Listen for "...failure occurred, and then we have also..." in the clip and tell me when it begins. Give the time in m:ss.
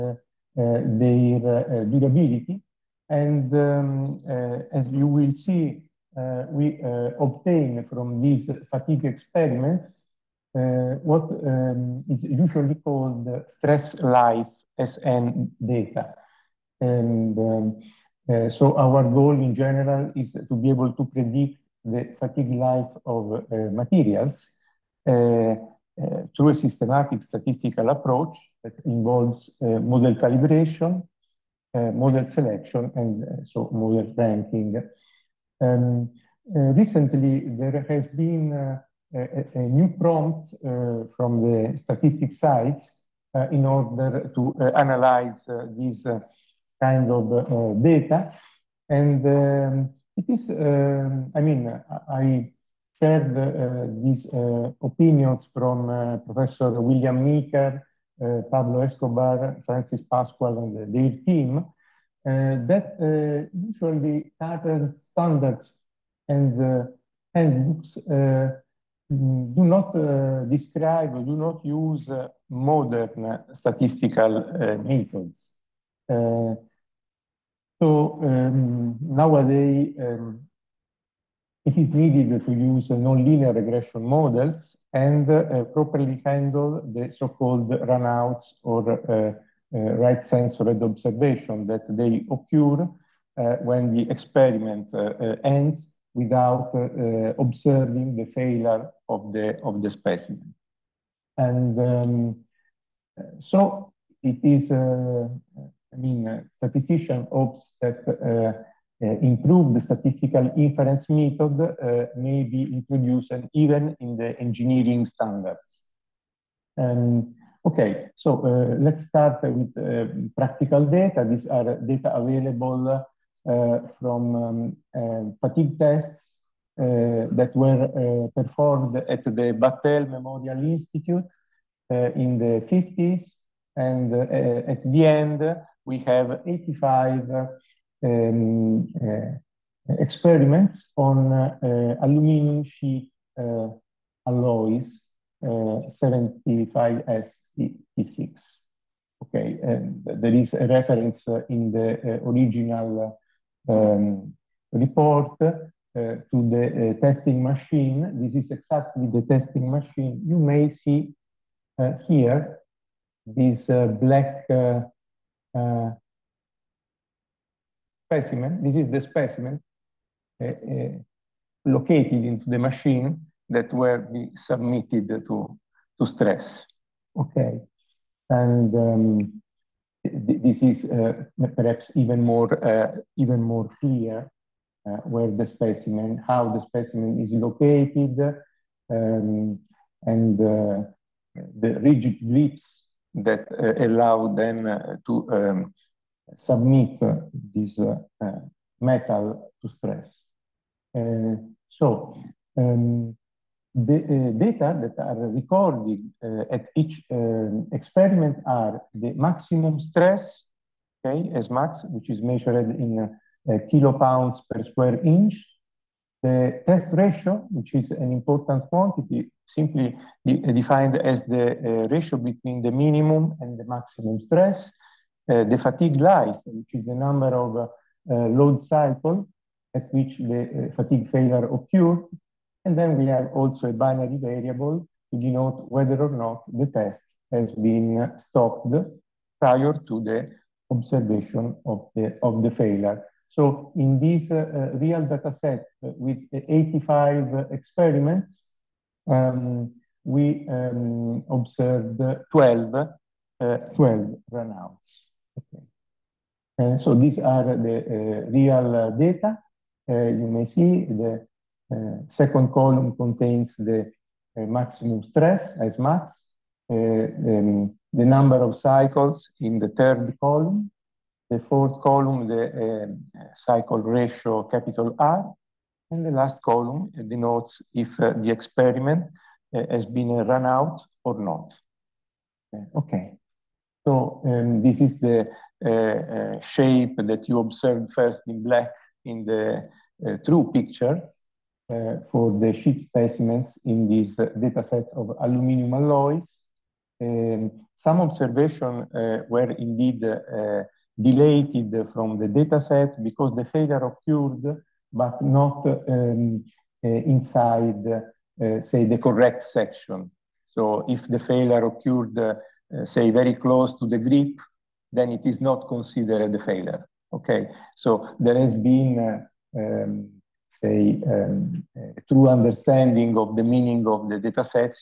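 3:51.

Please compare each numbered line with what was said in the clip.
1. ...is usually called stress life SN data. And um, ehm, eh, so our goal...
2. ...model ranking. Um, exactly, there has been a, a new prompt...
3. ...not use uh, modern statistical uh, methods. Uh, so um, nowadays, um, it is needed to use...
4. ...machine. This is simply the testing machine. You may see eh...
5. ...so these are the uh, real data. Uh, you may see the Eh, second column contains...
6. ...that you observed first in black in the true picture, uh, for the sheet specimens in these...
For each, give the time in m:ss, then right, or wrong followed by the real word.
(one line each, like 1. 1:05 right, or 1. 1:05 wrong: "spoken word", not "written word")
1. 0:12 right
2. 0:33 wrong: "recently", not "exactly"
3. 1:11 right
4. 2:37 wrong: "exactly", not "simply"
5. 4:16 right
6. 4:46 right.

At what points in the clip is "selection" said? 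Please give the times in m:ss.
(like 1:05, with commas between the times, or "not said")
0:32.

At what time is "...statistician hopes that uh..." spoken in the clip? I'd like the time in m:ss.
1:46.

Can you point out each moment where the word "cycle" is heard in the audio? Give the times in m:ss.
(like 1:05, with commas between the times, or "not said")
3:48, 4:28, 4:33.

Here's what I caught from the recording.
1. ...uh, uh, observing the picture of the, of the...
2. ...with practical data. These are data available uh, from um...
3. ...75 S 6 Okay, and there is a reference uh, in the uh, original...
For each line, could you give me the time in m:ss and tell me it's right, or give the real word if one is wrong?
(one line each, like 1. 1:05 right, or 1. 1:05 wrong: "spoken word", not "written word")
1. 1:36 wrong: "failure", not "picture"
2. 1:59 right
3. 2:25 right.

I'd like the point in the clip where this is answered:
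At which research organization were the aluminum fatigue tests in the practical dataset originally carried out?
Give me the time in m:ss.
2:09.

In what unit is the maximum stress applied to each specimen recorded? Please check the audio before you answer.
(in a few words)
kilopounds per square inch.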